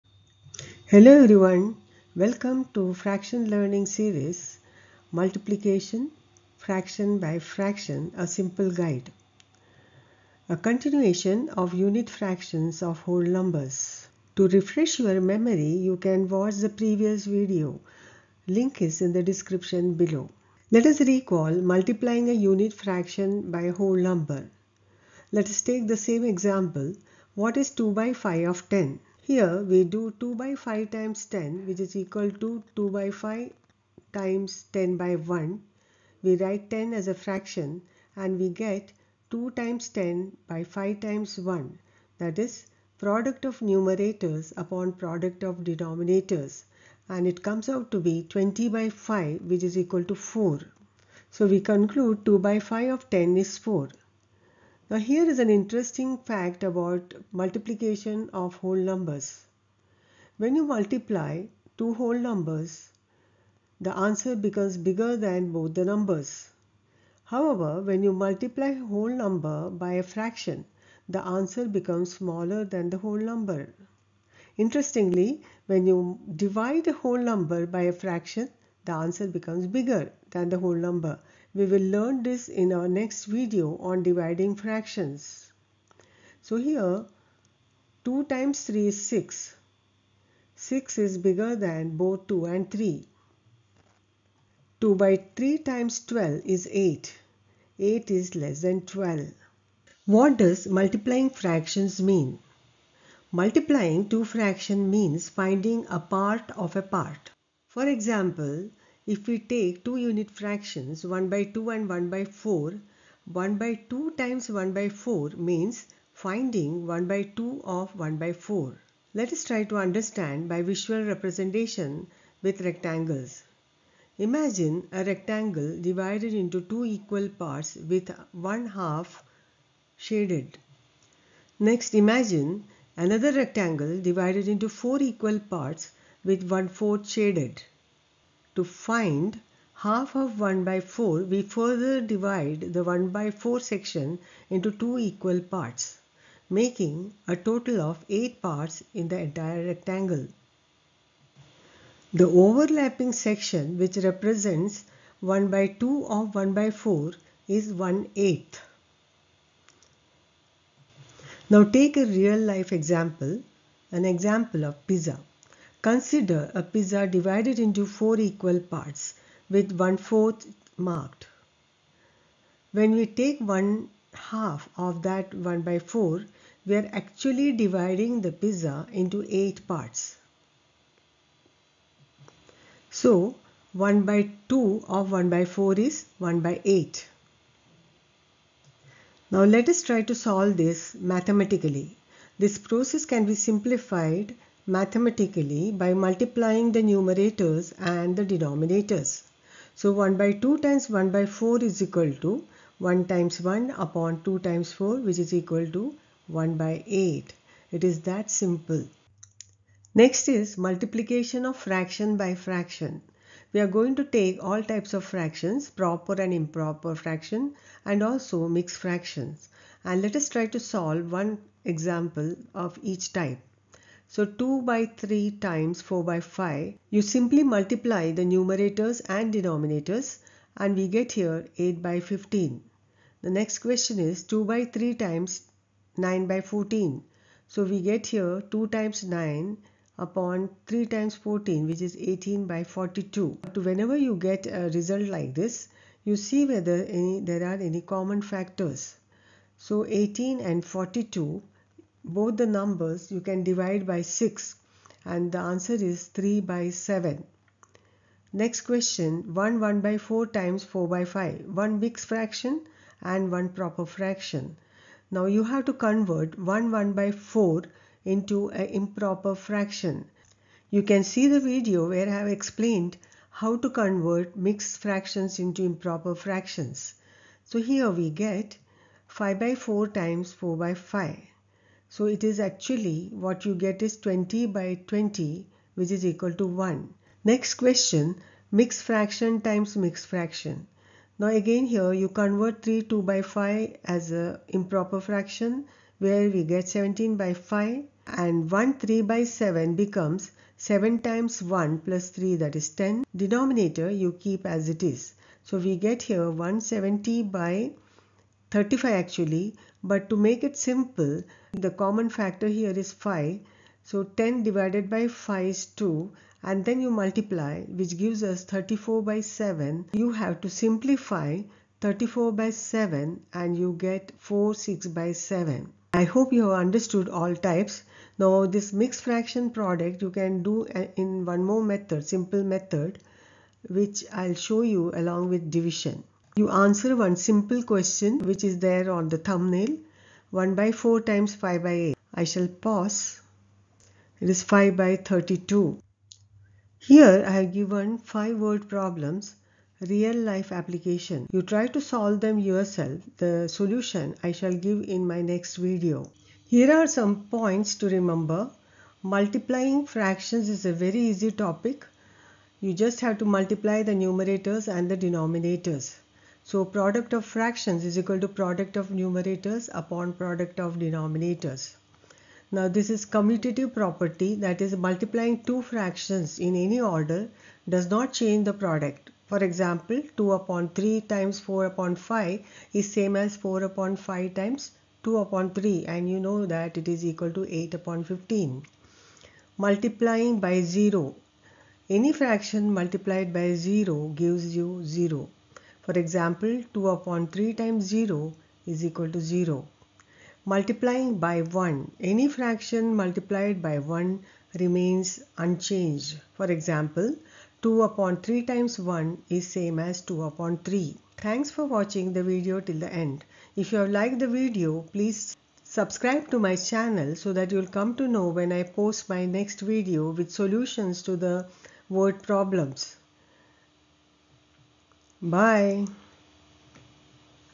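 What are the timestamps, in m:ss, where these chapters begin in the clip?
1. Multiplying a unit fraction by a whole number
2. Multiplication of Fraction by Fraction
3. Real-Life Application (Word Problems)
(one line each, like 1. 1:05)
1. 0:20
2. 3:29
3. 5:46.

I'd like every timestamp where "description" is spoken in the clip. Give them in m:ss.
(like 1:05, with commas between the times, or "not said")
0:19.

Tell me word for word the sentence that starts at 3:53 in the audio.
The next question is 2 by 3 times 9 by 14.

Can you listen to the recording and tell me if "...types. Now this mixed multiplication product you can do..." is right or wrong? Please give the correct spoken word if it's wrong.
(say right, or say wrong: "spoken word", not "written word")
wrong: "fraction", not "multiplication".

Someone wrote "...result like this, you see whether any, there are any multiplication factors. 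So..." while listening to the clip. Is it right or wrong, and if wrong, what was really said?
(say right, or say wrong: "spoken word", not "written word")
wrong: "common", not "multiplication".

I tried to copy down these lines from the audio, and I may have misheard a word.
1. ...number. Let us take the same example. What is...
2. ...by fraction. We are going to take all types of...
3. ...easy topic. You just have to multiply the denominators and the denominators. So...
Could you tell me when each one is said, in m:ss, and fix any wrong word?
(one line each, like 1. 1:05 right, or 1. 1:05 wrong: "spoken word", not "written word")
1. 0:23 right
2. 3:32 right
3. 6:01 wrong: "numerators", not "denominators".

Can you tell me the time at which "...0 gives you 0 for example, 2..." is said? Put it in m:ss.
6:33.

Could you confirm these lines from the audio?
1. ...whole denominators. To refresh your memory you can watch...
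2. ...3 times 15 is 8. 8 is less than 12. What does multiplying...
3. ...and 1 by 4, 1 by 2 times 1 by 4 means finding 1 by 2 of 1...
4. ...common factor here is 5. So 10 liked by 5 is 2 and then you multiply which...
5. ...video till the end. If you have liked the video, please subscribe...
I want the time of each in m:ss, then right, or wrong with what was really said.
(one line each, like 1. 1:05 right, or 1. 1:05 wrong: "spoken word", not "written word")
1. 0:12 wrong: "numbers", not "denominators"
2. 1:35 wrong: "12", not "15"
3. 1:51 right
4. 5:11 wrong: "divided", not "liked"
5. 6:52 right.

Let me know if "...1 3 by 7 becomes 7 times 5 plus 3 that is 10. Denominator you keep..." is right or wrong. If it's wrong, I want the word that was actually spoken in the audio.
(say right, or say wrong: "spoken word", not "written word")
wrong: "1", not "5".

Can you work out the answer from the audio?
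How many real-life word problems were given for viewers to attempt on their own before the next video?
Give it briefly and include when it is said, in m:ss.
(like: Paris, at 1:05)
5, at 5:47.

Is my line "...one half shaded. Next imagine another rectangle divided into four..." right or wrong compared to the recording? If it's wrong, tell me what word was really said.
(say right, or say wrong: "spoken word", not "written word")
right.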